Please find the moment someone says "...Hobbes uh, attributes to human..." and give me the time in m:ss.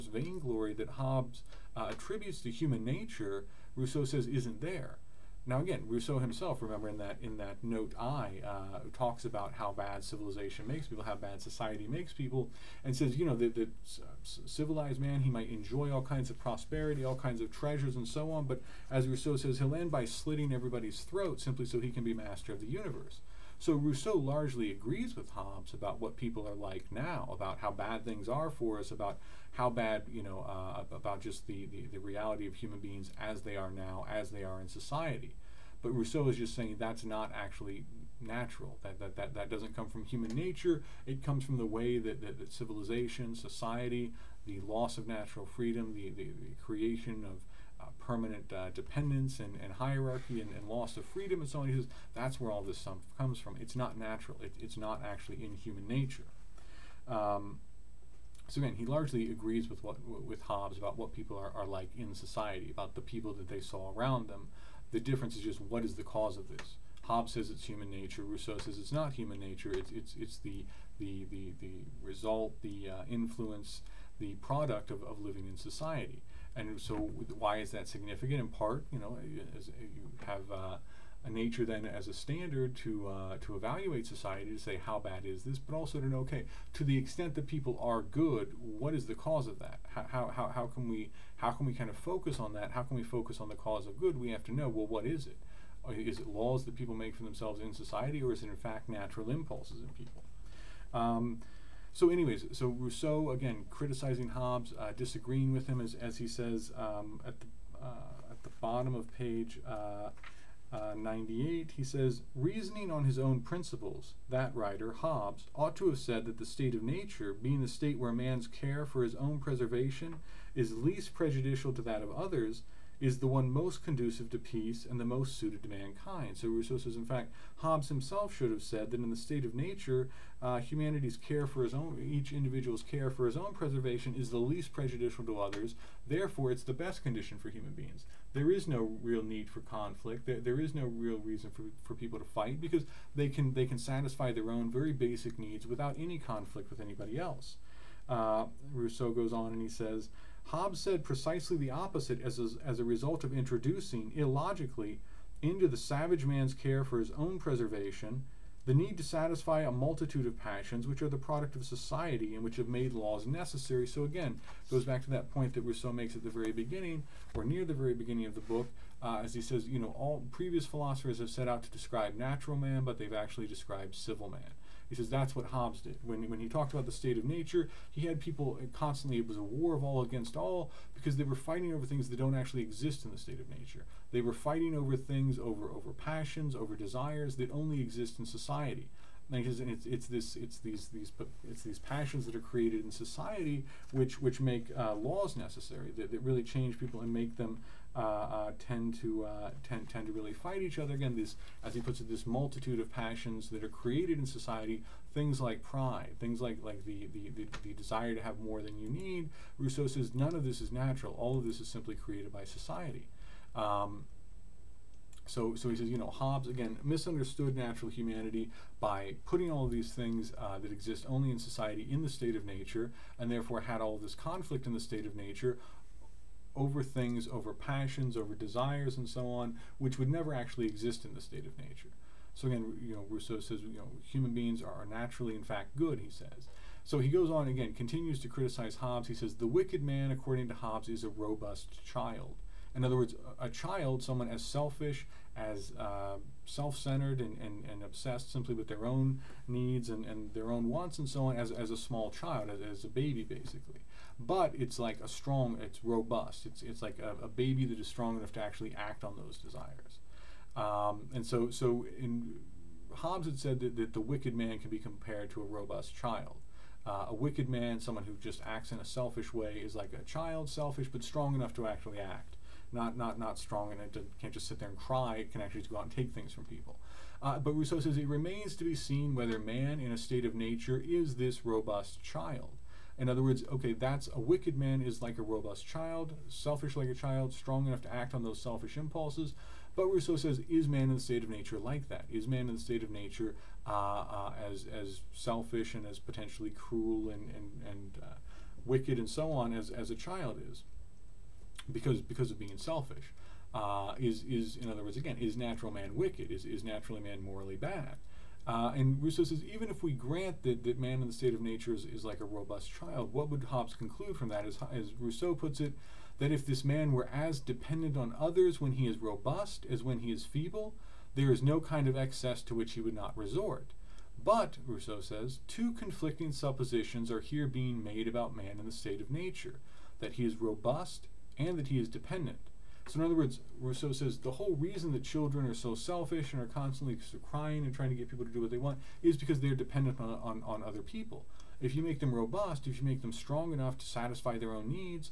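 0:00.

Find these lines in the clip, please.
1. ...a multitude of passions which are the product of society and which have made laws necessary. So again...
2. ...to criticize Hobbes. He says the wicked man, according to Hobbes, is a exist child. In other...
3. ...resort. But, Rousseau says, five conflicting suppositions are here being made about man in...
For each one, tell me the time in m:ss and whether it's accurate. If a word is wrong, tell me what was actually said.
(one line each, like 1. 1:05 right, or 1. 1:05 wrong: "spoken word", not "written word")
1. 2:39 right
2. 3:58 wrong: "robust", not "exist"
3. 5:23 wrong: "two", not "five".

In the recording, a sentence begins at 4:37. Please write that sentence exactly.
Uh, but Rousseau says it remains to be seen whether man in a state of nature is this robust child.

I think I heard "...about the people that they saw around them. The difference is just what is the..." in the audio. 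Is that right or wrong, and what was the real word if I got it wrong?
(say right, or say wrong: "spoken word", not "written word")
right.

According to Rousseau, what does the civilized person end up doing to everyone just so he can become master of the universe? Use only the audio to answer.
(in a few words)
slitting everybody's throat.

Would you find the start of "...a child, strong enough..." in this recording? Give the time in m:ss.
4:46.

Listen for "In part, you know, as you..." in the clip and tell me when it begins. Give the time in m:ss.
1:18.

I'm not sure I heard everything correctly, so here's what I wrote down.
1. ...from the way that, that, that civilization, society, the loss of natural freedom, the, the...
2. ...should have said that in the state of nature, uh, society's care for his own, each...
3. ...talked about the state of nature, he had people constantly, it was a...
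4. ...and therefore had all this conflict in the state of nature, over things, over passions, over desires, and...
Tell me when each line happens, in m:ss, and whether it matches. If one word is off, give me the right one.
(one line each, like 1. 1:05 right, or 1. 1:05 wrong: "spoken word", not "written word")
1. 0:41 right
2. 2:08 wrong: "humanity", not "society"
3. 2:56 right
4. 3:43 right.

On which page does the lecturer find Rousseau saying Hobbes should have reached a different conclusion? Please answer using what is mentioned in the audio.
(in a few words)
98.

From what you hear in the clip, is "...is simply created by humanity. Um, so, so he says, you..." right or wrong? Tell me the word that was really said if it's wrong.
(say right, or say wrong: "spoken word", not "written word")
wrong: "society", not "humanity".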